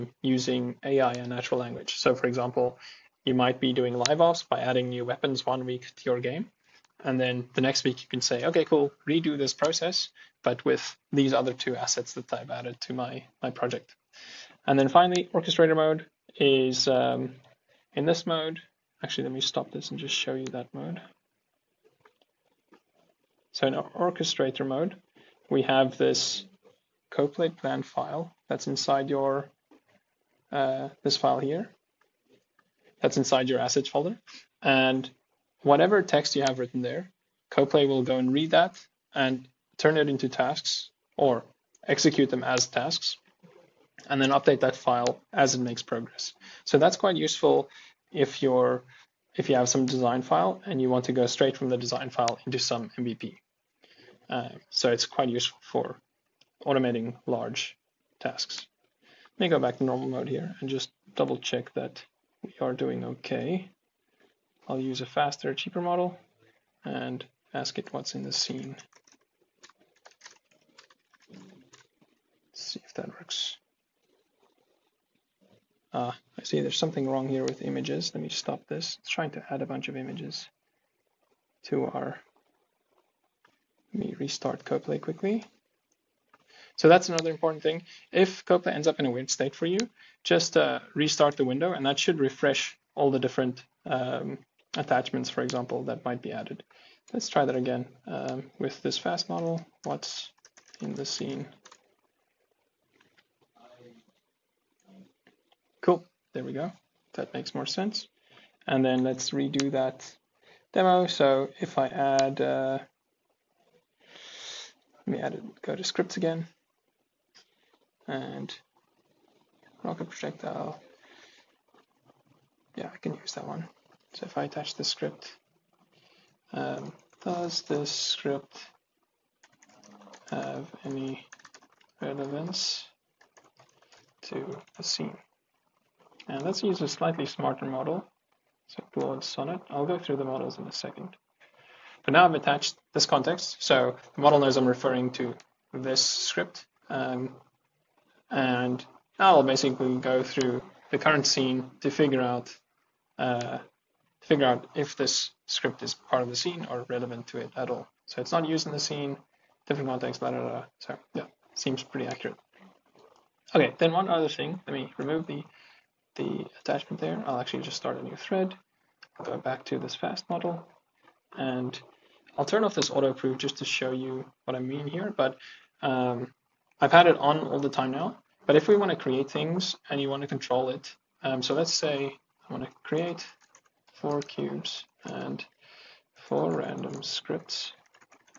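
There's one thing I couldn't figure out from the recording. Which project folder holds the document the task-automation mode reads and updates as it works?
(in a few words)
assets folder.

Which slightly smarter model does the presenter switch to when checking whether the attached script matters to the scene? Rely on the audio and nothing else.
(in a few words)
Claude Sonnet.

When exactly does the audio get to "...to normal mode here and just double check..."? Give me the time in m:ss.
0:59.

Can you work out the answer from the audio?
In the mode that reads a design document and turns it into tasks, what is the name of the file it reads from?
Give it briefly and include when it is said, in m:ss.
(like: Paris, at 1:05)
Coplay plan file, at 0:27.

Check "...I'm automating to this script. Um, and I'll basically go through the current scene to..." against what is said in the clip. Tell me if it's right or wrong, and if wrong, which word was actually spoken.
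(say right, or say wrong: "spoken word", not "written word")
wrong: "referring", not "automating".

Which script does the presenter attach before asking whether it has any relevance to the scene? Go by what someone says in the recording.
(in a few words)
rocket projectile.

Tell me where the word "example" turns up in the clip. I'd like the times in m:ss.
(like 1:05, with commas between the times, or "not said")
0:02, 1:35.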